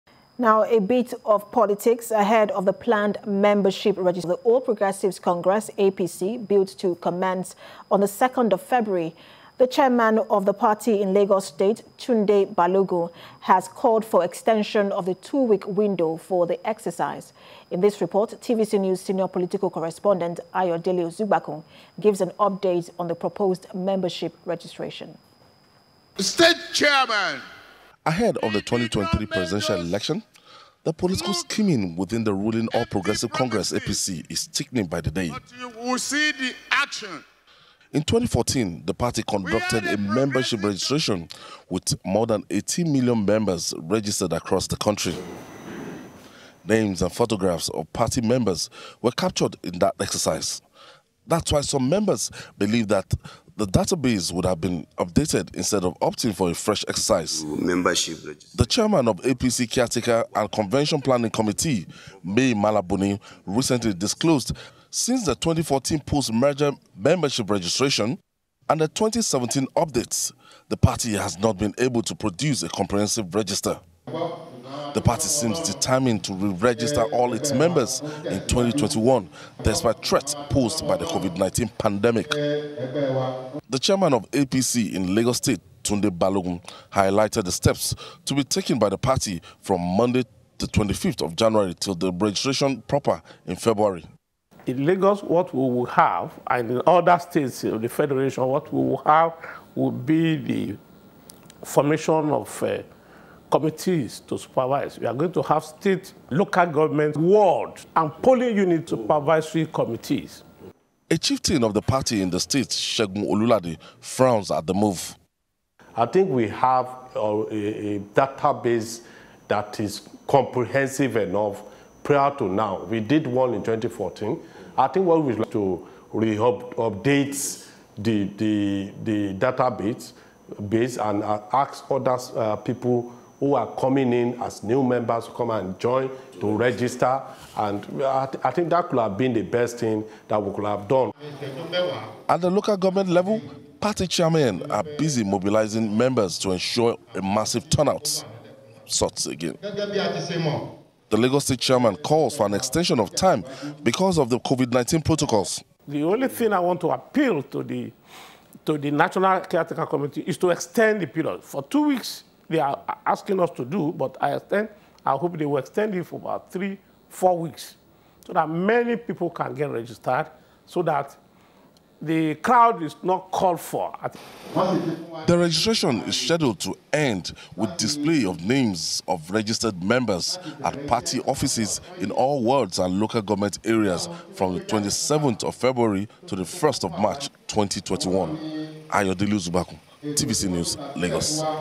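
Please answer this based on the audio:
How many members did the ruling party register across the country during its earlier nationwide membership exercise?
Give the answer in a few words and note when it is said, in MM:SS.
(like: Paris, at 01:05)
More than 18 million, at 00:42.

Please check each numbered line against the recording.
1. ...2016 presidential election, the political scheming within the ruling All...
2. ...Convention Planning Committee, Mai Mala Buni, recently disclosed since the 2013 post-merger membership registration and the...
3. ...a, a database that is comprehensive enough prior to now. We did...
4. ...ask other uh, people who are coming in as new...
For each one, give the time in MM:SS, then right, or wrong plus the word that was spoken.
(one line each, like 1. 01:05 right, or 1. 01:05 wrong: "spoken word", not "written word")
1. 00:28 wrong: "2023", not "2016"
2. 01:00 wrong: "2014", not "2013"
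3. 01:57 right
4. 02:11 right.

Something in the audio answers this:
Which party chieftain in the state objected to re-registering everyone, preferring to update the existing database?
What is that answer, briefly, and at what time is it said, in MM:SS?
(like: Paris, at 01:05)
Shegun Olulade, at 01:52.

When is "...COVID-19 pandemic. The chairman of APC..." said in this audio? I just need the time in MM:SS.
01:21.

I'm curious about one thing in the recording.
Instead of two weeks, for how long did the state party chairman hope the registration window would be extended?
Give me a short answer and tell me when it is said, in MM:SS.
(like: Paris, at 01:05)
3 to 4 weeks, at 02:46.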